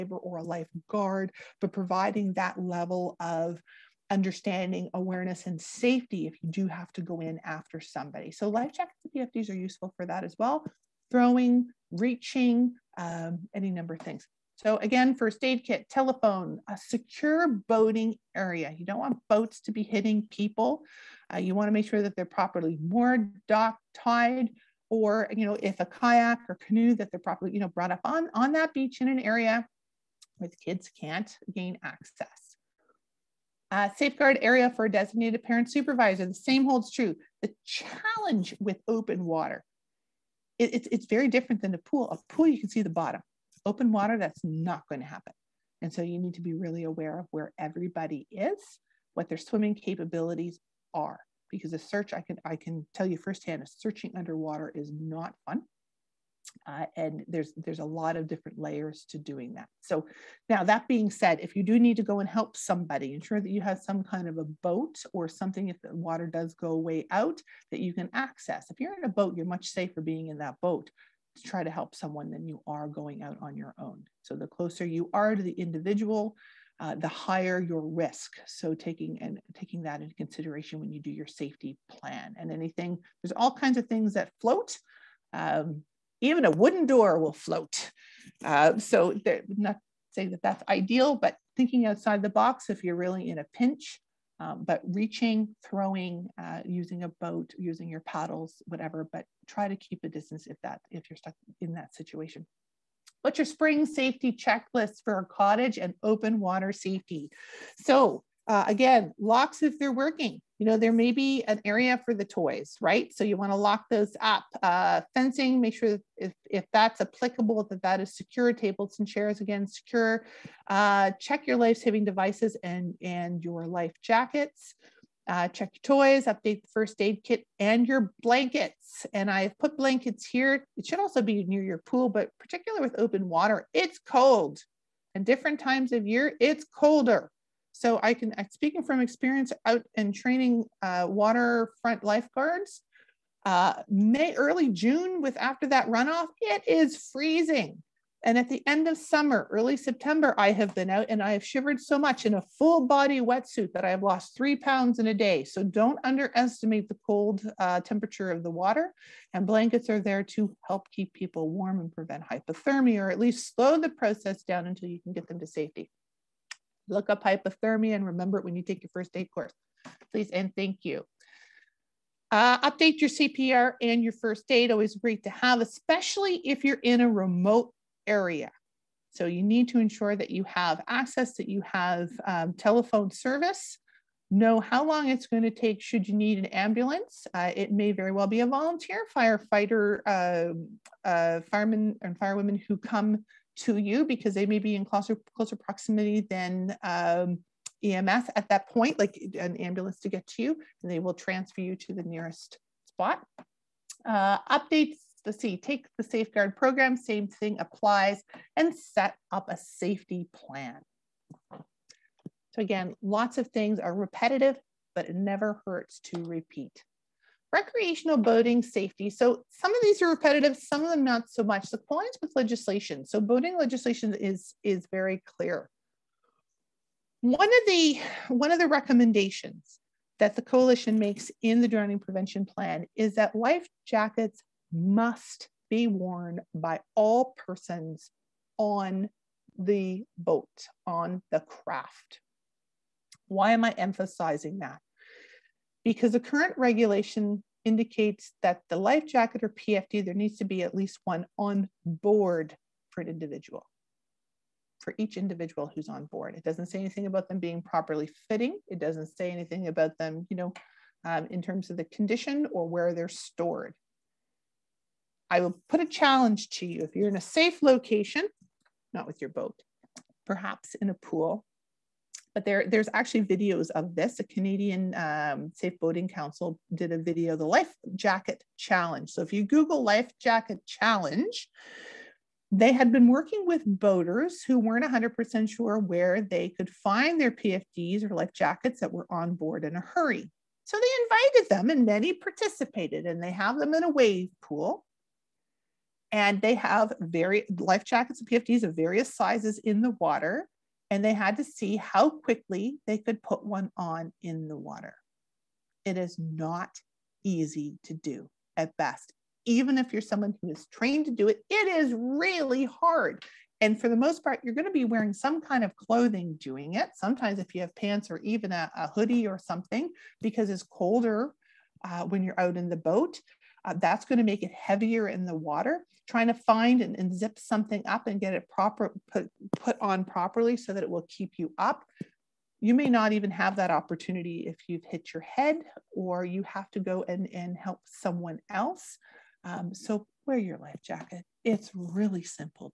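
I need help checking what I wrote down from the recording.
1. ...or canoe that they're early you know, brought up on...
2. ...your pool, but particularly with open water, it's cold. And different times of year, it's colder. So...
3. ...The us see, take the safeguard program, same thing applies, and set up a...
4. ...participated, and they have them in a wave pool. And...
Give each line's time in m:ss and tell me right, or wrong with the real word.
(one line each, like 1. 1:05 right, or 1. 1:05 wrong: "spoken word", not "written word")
1. 0:26 wrong: "properly", not "early"
2. 2:11 right
3. 3:25 right
4. 4:52 right.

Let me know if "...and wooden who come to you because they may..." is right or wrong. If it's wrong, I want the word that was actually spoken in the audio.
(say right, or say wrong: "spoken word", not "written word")
wrong: "firewomen", not "wooden".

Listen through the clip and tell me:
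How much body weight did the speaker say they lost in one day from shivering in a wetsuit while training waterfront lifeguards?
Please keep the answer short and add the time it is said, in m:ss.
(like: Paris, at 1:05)
3 pounds, at 2:34.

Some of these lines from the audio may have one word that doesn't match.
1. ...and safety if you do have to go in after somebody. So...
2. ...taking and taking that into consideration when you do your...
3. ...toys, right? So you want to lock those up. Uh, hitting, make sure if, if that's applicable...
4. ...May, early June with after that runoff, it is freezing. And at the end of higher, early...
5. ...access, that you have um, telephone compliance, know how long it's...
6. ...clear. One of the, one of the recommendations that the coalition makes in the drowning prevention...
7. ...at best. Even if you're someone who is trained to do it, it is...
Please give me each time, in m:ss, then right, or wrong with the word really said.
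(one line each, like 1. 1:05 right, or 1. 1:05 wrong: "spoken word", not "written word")
1. 0:05 right
2. 1:18 right
3. 1:52 wrong: "fencing", not "hitting"
4. 2:23 wrong: "summer", not "higher"
5. 3:00 wrong: "service", not "compliance"
6. 3:45 right
7. 5:08 right.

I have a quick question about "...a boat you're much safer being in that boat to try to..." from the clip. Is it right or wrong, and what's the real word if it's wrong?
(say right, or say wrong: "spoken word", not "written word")
right.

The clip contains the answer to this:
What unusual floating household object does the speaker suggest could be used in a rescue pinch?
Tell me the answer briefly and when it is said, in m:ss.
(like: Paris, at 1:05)
wooden door, at 1:26.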